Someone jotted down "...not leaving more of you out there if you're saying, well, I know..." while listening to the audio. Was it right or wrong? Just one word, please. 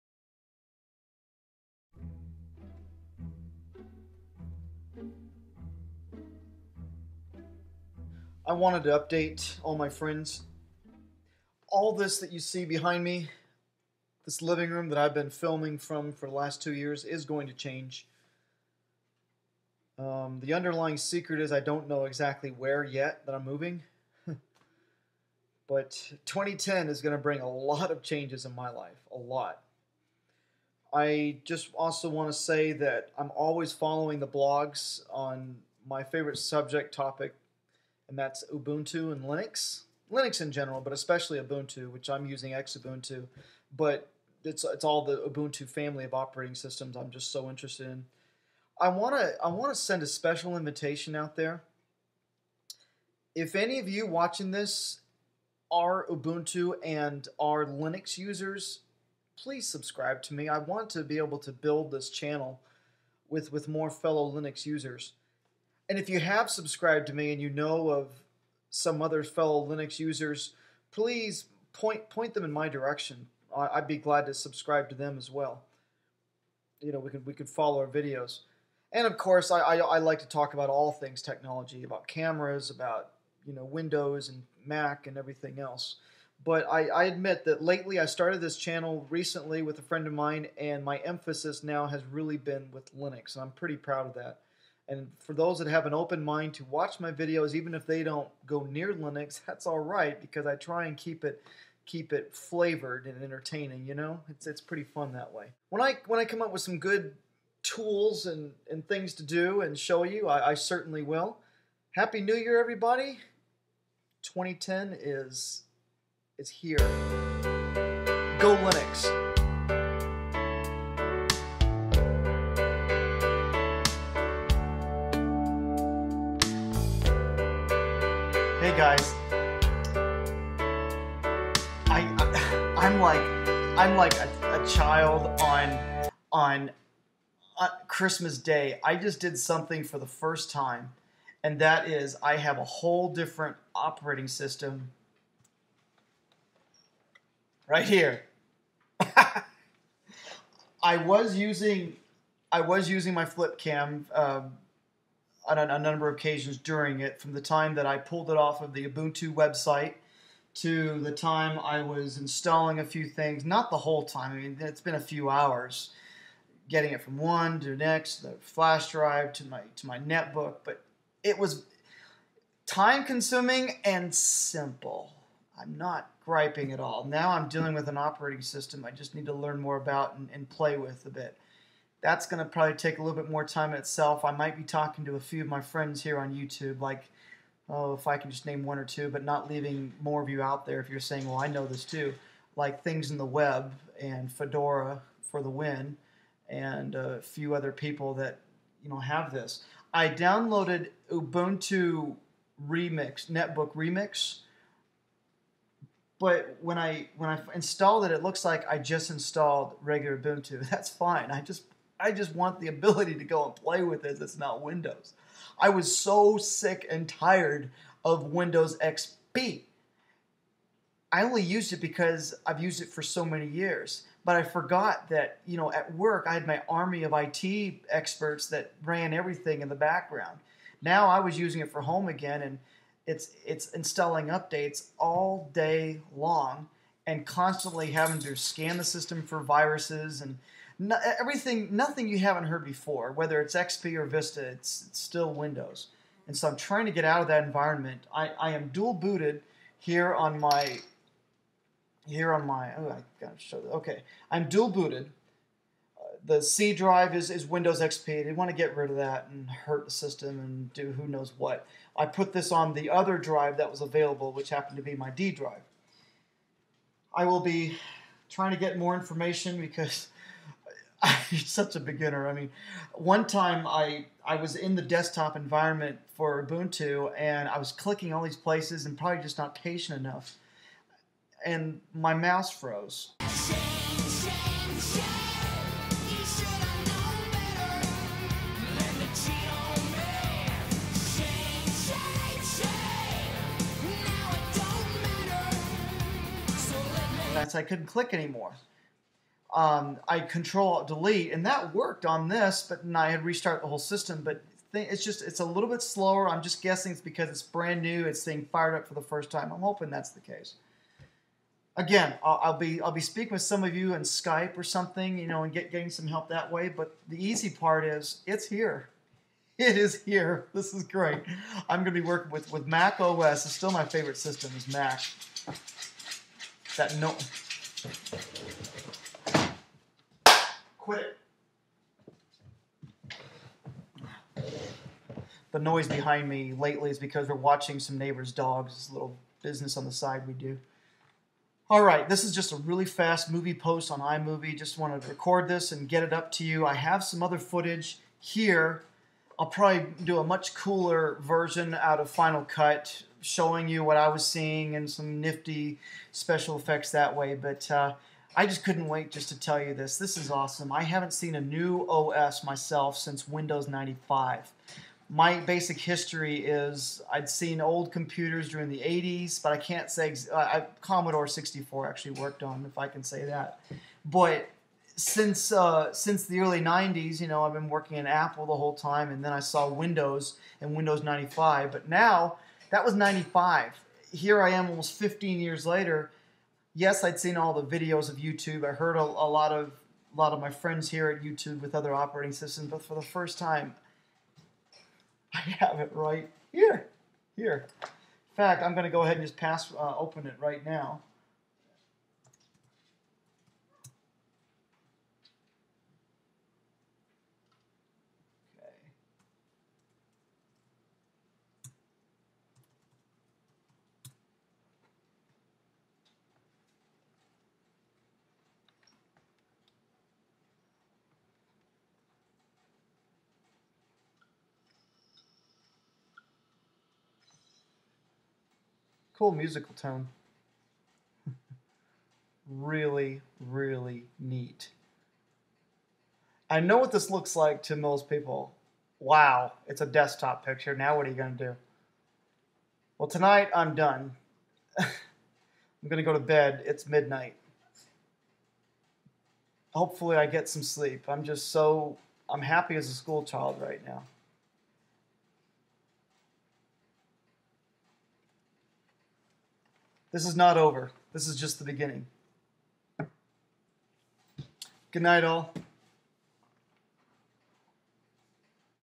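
right.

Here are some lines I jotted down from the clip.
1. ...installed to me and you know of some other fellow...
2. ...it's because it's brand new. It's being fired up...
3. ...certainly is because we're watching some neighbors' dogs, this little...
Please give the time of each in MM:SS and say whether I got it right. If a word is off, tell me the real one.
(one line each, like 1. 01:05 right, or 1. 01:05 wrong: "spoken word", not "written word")
1. 01:06 wrong: "subscribed", not "installed"
2. 05:06 right
3. 05:36 wrong: "lately", not "certainly".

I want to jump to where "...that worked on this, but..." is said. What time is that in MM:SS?
05:01.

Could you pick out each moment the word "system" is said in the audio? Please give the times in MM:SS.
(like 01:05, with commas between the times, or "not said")
00:46, 02:24, 02:58, 03:58, 04:19, 05:03, 05:24, 06:32.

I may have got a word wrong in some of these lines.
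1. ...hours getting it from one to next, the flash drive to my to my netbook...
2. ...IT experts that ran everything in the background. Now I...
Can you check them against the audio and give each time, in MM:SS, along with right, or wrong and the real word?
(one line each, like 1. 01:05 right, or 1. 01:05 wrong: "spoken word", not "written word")
1. 02:45 right
2. 03:47 right.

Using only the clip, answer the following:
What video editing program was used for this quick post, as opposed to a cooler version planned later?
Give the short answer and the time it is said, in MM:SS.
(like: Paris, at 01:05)
iMovie, at 05:43.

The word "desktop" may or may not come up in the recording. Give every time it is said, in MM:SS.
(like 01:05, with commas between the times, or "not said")
04:34, 07:19.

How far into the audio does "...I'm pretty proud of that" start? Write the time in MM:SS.
01:33.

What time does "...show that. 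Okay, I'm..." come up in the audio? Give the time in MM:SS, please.
04:13.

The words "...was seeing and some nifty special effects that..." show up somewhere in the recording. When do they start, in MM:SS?
05:54.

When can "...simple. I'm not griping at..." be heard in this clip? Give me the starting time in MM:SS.
02:54.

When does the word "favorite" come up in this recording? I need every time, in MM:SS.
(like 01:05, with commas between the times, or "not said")
00:36, 05:23.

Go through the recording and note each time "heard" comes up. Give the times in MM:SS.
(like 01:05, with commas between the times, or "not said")
04:02, 06:28.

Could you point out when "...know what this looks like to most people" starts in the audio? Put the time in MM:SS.
07:16.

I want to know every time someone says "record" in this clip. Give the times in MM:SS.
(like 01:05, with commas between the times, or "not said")
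05:45.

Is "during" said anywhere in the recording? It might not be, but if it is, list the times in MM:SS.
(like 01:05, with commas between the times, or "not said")
02:36, 06:08.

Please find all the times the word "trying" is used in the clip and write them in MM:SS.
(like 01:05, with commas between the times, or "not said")
04:06, 04:28.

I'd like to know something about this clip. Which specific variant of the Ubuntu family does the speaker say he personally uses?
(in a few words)
Xubuntu.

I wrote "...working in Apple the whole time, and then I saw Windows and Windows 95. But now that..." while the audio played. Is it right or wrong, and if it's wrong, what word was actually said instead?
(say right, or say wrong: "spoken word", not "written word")
right.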